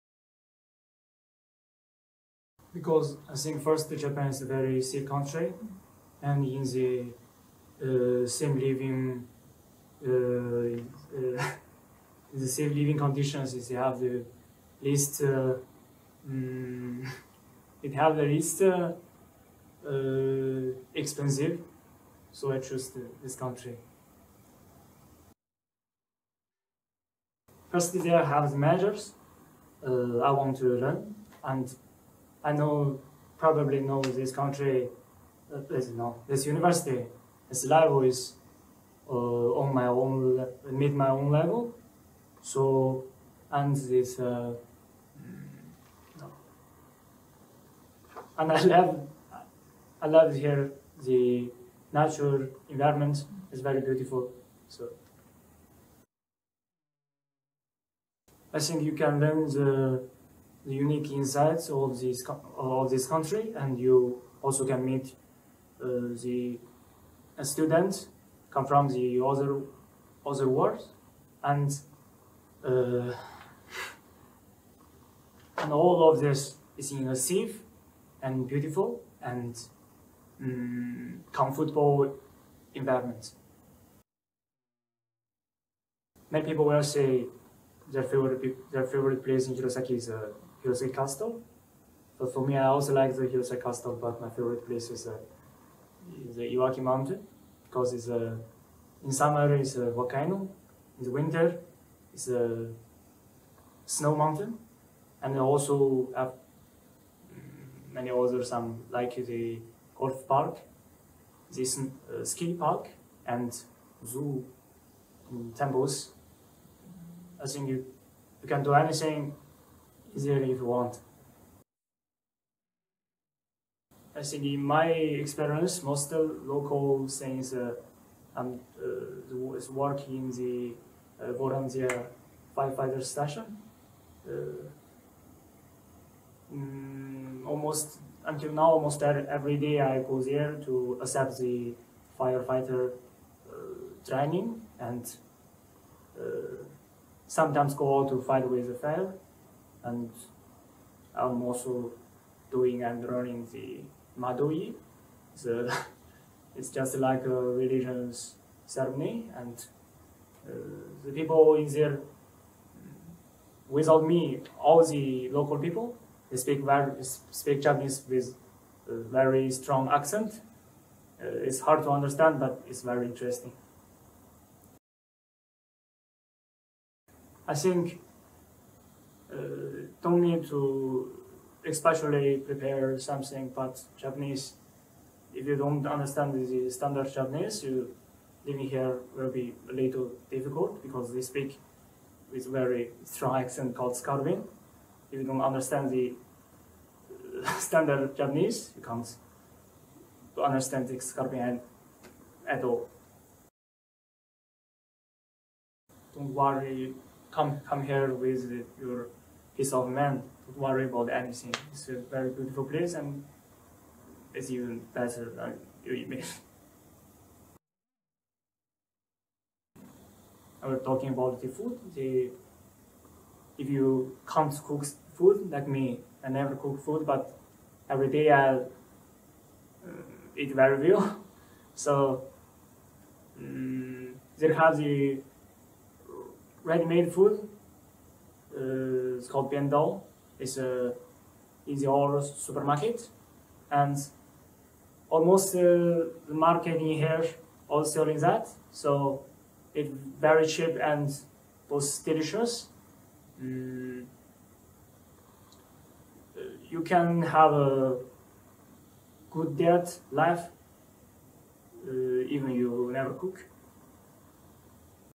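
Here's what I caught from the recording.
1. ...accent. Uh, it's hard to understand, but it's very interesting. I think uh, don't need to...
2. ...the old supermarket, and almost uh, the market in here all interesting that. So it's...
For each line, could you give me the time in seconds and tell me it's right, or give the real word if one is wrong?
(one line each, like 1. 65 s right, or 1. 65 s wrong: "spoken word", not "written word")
1. 169 s right
2. 241 s wrong: "selling", not "interesting".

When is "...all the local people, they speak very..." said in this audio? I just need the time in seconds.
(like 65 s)
164 s.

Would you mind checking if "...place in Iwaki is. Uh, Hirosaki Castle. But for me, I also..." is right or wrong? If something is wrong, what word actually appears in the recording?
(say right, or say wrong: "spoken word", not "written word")
wrong: "Hirosaki", not "Iwaki".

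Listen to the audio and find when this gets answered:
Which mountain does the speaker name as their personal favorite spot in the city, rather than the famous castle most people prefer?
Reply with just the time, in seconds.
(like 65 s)
96 s.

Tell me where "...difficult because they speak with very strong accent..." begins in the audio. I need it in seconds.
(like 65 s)
190 s.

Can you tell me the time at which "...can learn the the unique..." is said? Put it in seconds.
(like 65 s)
58 s.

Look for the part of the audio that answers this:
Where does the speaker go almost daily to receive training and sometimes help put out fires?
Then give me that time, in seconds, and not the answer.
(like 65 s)
131 s.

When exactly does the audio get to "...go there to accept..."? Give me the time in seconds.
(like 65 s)
139 s.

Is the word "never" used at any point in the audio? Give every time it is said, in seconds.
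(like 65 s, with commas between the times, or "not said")
226 s, 262 s.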